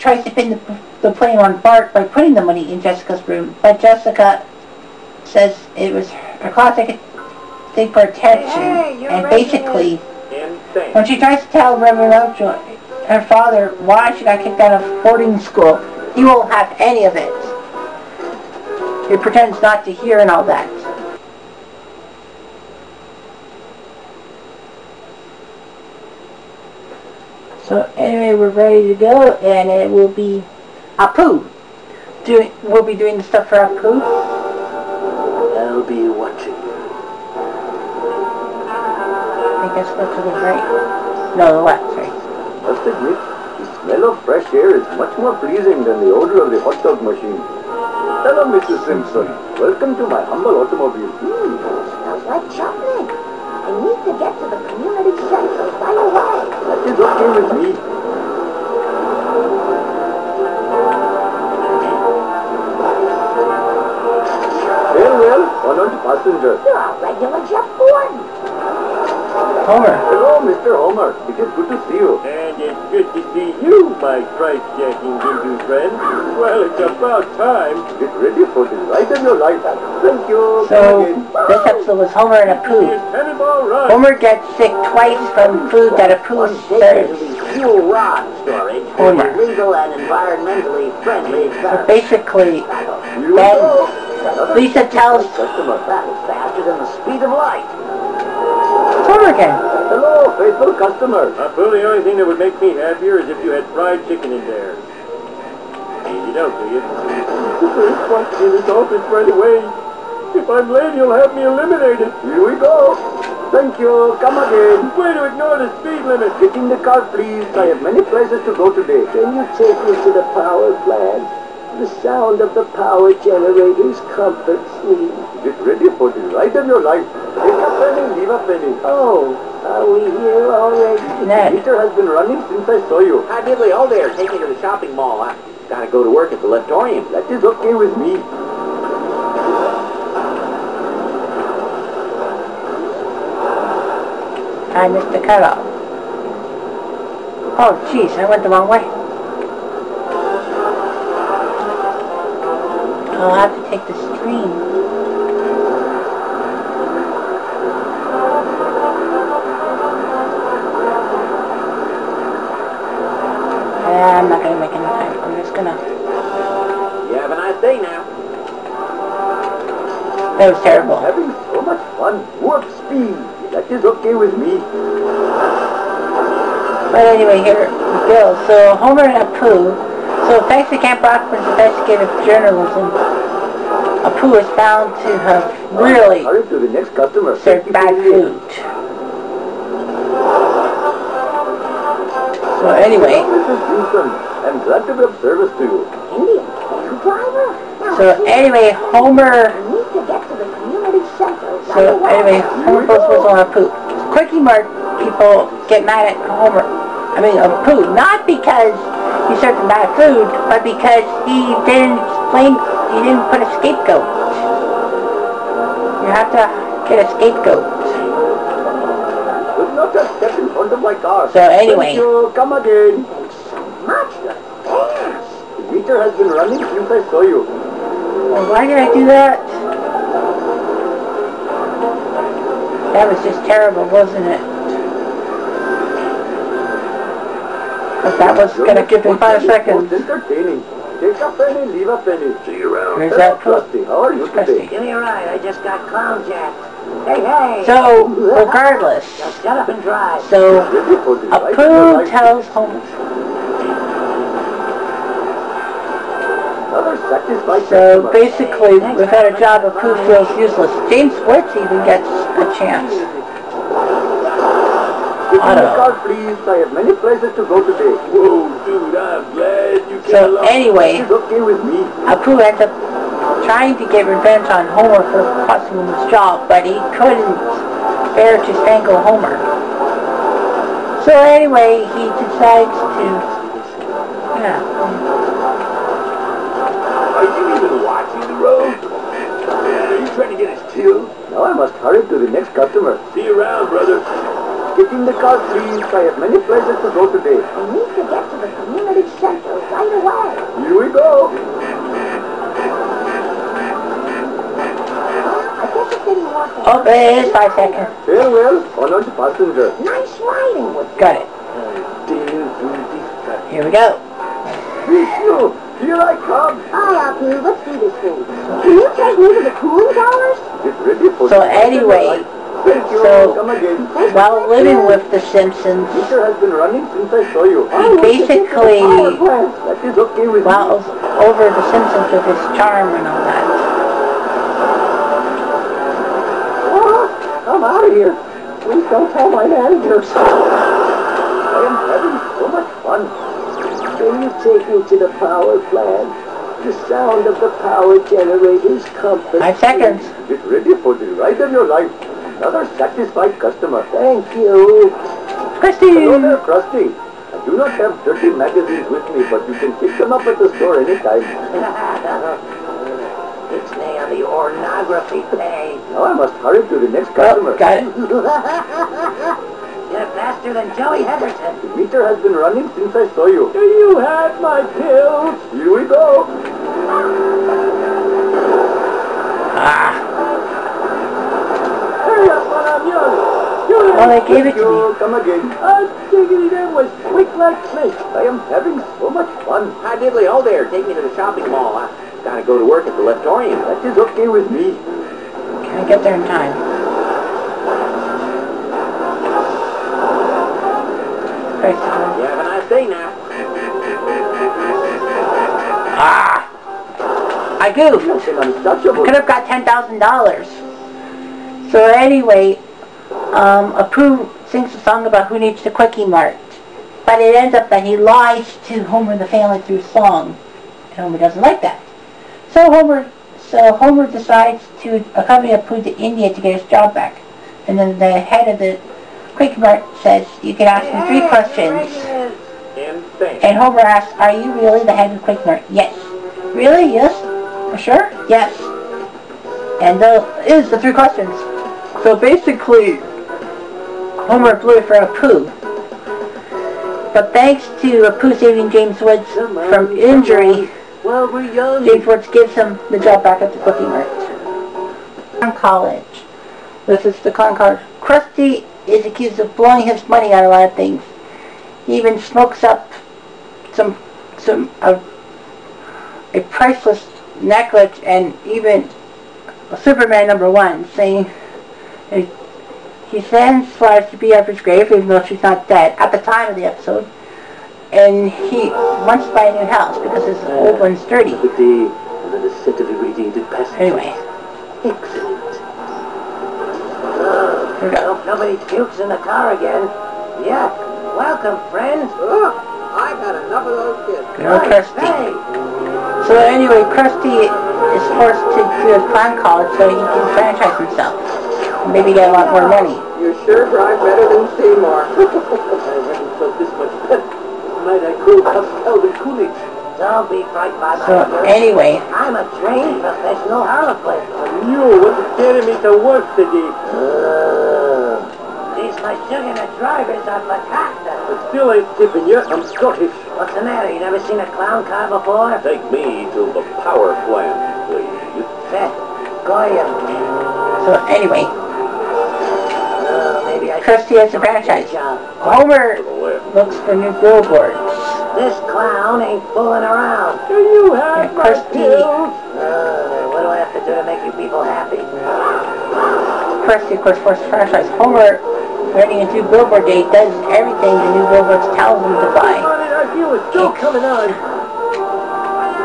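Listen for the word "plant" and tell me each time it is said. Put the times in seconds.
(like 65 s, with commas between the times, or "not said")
120 s, 345 s, 527 s.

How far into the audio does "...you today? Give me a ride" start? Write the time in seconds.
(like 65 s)
244 s.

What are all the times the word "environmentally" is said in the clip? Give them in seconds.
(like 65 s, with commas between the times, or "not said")
90 s.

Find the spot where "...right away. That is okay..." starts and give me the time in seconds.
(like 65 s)
55 s.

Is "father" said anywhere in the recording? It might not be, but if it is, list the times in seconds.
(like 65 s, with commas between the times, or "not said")
13 s.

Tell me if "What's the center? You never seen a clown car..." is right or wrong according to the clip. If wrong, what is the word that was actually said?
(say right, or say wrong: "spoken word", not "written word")
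wrong: "matter", not "center".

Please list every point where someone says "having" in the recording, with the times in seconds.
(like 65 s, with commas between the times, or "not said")
171 s, 341 s, 388 s.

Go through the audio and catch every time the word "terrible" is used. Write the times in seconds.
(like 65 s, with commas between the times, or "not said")
170 s, 233 s.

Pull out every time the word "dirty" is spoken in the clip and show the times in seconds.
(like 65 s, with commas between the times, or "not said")
358 s, 481 s.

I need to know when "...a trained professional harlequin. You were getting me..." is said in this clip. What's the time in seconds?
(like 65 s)
512 s.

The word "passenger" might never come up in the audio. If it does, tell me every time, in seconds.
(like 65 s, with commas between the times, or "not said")
66 s, 309 s.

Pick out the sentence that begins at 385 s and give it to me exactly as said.
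I figured that was quick like this.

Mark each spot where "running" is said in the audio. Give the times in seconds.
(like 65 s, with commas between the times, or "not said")
132 s, 226 s, 326 s, 372 s.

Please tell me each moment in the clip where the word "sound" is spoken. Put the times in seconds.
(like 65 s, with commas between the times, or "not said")
122 s, 346 s.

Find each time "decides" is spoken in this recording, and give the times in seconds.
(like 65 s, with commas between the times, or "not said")
282 s, 424 s.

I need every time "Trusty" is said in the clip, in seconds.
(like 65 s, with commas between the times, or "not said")
243 s.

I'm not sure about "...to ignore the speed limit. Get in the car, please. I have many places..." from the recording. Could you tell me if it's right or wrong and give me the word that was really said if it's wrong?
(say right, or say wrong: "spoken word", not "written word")
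right.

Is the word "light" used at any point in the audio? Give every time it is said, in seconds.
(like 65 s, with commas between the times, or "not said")
78 s, 97 s.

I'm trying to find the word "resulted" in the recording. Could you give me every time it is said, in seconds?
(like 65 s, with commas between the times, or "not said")
108 s.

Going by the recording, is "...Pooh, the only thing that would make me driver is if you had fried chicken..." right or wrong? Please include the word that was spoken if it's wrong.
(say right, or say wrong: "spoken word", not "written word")
wrong: "happier", not "driver".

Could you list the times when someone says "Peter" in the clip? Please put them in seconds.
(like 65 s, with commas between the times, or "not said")
131 s, 325 s.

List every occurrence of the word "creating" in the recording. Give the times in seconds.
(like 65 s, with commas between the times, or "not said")
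548 s.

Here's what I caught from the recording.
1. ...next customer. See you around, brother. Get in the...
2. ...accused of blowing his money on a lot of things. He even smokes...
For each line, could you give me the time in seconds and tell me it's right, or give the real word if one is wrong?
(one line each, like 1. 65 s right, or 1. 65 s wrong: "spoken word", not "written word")
1. 292 s right
2. 459 s right.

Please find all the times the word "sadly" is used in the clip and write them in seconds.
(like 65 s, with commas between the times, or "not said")
not said.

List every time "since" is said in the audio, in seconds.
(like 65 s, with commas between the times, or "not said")
132 s, 226 s, 326 s, 372 s.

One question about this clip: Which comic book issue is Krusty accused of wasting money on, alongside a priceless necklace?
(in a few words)
Superman number one.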